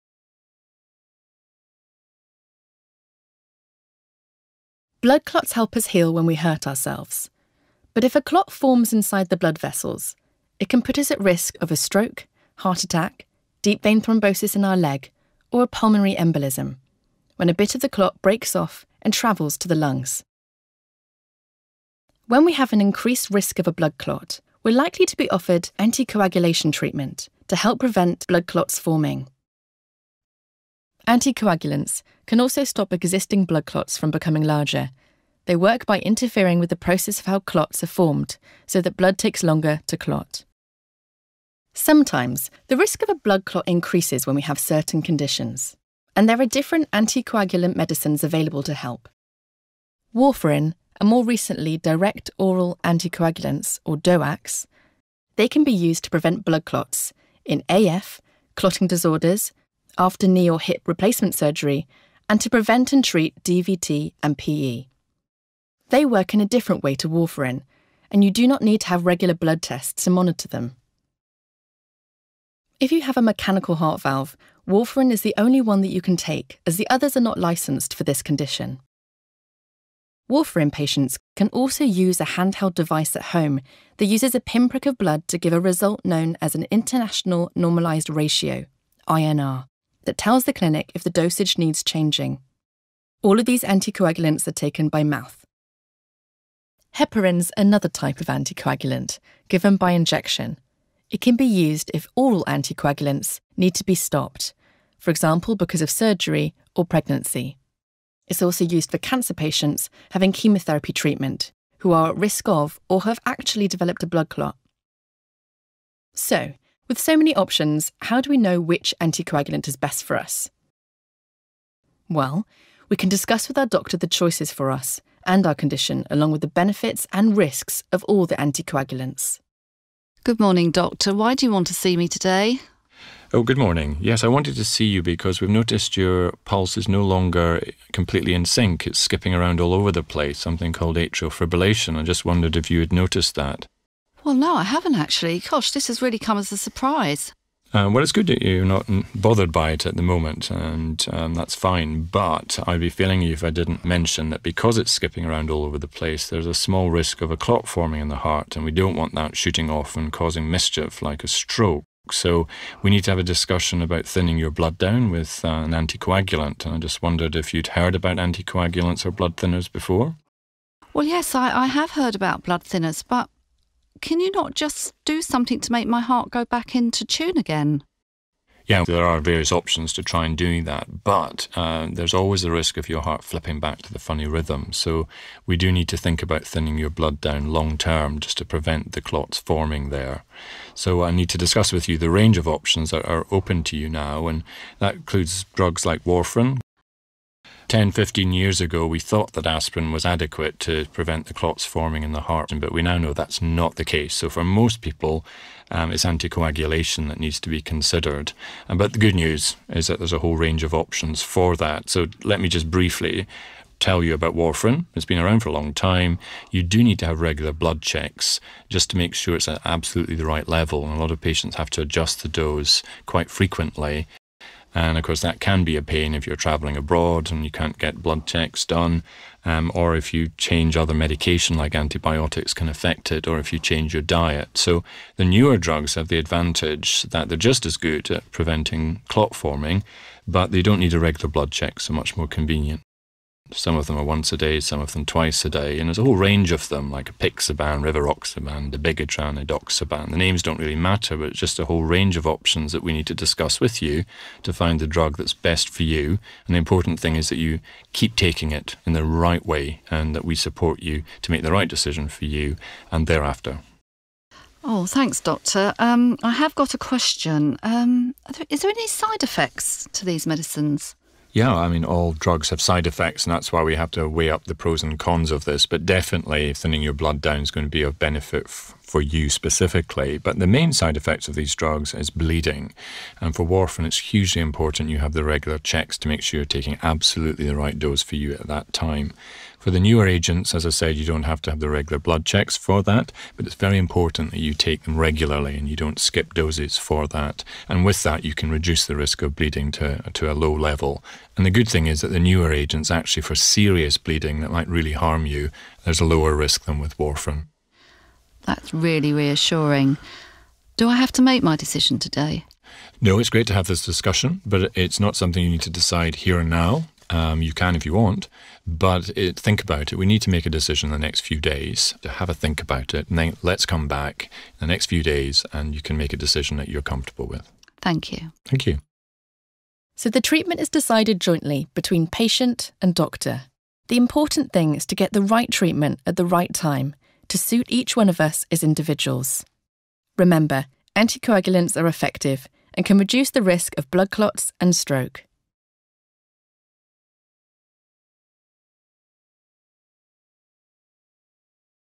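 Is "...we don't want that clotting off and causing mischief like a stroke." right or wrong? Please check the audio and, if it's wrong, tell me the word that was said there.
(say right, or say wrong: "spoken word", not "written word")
wrong: "shooting", not "clotting".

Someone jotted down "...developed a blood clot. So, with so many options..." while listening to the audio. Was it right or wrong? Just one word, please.
right.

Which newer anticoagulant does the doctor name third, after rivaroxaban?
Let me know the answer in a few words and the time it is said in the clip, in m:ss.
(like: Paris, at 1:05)
Dabigatran, at 4:08.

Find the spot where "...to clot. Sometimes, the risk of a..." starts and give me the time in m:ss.
0:39.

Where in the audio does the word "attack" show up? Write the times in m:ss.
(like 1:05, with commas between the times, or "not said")
0:12.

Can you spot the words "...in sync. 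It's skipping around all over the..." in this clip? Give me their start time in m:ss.
2:18.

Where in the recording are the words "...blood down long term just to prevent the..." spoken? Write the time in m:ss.
3:06.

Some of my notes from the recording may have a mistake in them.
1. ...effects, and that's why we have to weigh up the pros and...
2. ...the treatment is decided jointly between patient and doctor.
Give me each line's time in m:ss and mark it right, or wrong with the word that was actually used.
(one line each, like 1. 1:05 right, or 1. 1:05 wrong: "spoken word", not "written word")
1. 4:32 right
2. 5:30 right.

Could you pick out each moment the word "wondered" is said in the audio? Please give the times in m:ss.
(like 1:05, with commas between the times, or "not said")
2:22, 2:47.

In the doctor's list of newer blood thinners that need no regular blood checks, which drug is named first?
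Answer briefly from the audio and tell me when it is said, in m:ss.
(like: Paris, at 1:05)
Apixaban, at 4:07.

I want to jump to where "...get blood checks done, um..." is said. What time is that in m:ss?
3:47.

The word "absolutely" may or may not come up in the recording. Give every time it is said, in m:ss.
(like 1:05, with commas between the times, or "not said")
3:39, 4:46.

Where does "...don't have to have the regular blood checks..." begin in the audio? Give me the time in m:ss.
4:51.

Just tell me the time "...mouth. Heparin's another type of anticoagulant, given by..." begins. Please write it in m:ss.
1:35.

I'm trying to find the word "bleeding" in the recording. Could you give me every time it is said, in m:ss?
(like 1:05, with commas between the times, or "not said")
4:42, 4:59, 5:03.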